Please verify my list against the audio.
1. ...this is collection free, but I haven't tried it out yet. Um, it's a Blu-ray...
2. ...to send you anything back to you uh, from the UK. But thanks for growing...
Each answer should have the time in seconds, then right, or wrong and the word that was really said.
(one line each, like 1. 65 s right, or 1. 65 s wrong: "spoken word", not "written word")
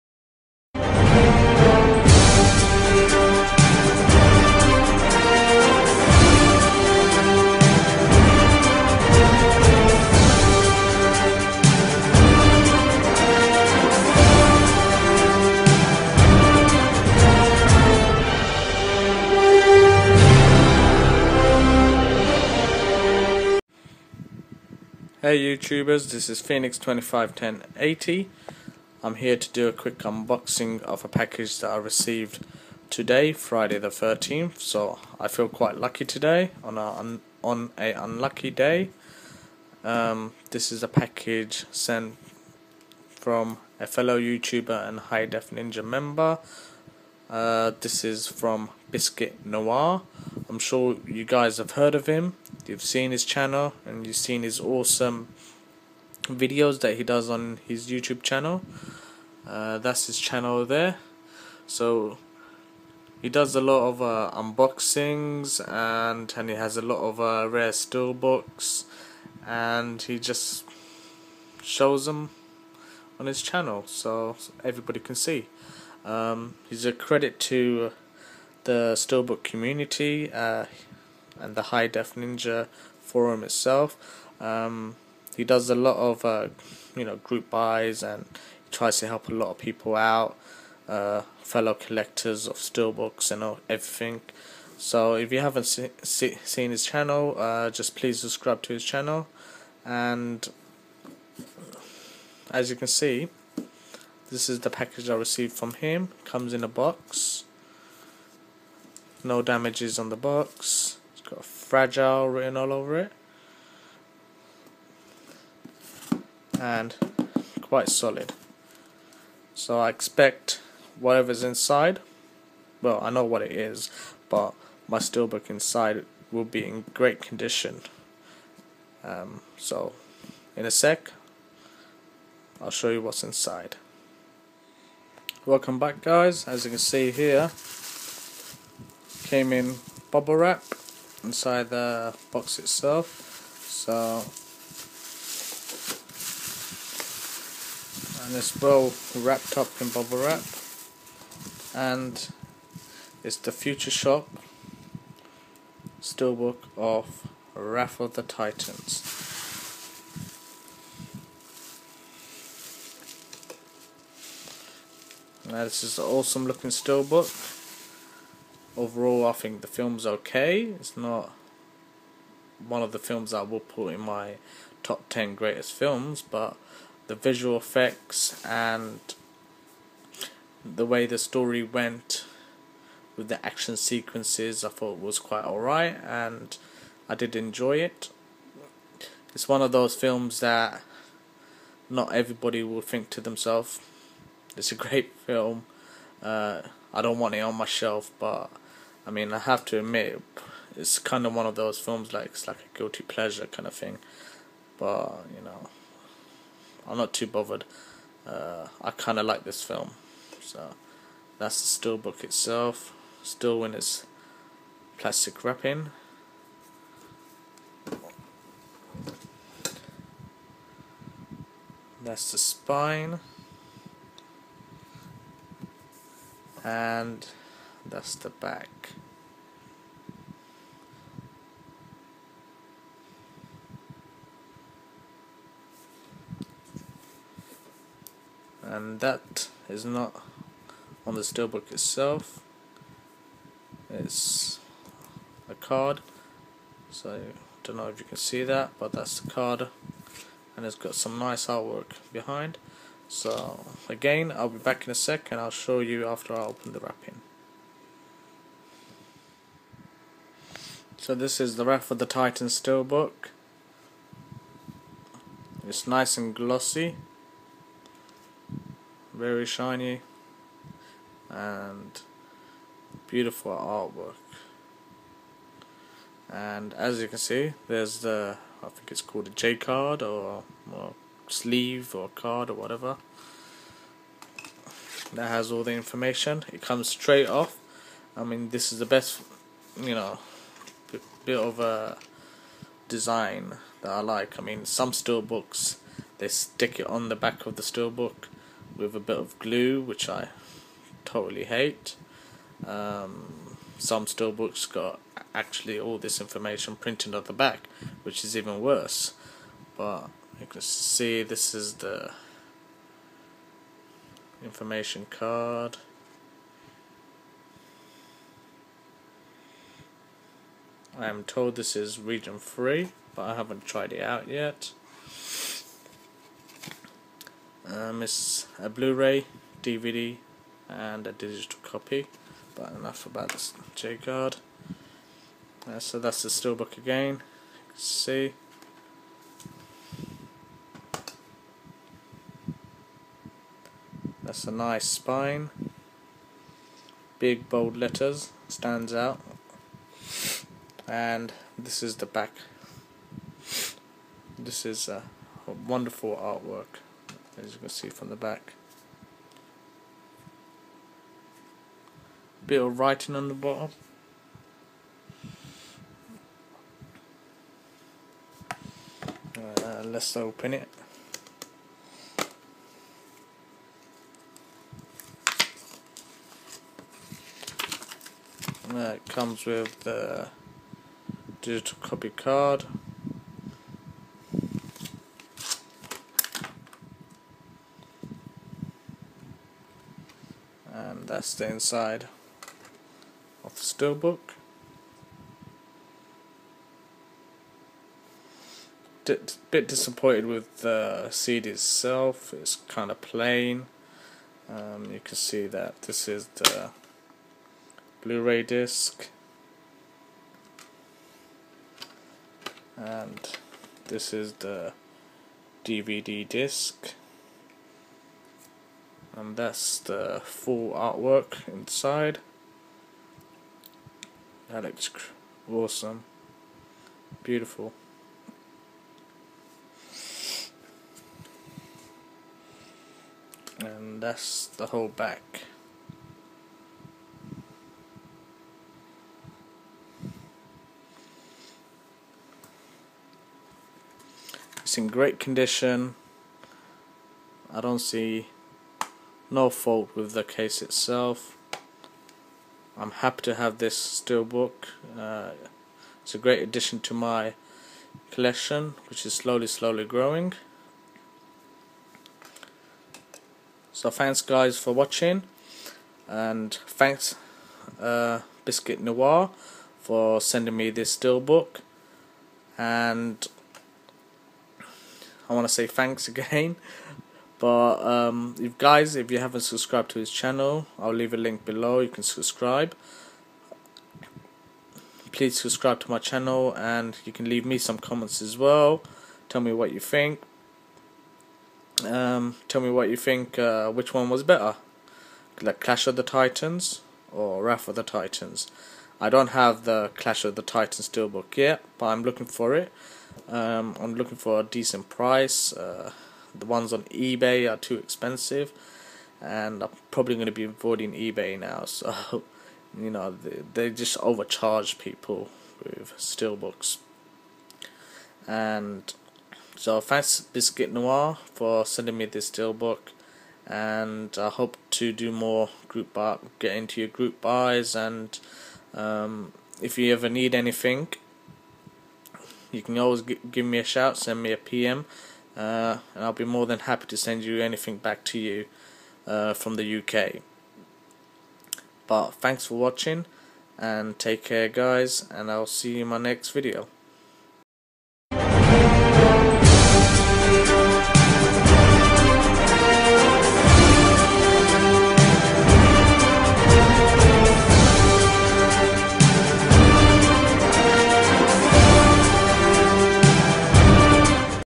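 1. 321 s wrong: "region", not "collection"
2. 536 s wrong: "watching", not "growing".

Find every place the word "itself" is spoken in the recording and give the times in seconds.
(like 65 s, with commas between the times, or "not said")
83 s, 142 s, 212 s, 241 s, 401 s, 450 s.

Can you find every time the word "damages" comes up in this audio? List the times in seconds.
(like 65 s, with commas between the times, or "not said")
109 s.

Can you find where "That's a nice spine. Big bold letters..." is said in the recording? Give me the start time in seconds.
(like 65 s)
344 s.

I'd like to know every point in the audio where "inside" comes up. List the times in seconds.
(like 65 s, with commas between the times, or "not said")
121 s, 125 s, 133 s, 141 s, 391 s, 421 s.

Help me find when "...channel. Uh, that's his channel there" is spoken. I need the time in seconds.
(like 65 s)
58 s.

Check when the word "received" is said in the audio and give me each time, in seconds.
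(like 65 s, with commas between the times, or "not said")
31 s, 105 s.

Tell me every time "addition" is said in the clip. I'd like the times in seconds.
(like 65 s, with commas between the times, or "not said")
456 s.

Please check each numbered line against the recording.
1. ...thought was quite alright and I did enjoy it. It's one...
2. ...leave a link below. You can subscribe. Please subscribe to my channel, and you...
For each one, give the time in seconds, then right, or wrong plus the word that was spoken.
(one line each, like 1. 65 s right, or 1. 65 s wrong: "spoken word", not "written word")
1. 184 s right
2. 480 s right.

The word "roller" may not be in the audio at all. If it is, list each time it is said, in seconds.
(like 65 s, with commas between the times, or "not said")
not said.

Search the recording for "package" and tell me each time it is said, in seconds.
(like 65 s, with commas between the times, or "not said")
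31 s, 40 s, 104 s.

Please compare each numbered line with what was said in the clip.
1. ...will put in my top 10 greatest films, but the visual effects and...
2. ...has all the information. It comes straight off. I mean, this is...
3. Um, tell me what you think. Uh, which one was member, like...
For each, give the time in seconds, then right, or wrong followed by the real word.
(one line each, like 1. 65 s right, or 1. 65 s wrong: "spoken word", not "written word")
1. 173 s right
2. 285 s right
3. 491 s wrong: "better", not "member".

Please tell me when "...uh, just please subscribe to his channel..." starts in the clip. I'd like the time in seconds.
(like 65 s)
97 s.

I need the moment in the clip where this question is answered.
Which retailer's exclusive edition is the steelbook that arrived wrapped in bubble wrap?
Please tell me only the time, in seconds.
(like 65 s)
153 s.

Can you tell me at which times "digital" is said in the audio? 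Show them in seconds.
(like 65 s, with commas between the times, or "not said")
331 s, 381 s.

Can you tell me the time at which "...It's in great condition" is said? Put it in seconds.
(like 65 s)
444 s.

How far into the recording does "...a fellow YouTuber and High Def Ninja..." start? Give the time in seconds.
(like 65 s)
43 s.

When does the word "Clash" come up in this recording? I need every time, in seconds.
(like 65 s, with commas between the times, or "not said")
495 s, 499 s.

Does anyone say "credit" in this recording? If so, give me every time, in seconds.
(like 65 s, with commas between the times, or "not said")
76 s.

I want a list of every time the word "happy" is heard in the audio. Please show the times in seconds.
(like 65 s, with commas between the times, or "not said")
452 s, 536 s.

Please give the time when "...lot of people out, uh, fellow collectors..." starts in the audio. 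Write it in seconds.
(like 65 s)
89 s.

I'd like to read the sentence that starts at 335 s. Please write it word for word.
Uh, so that's the steelbook again.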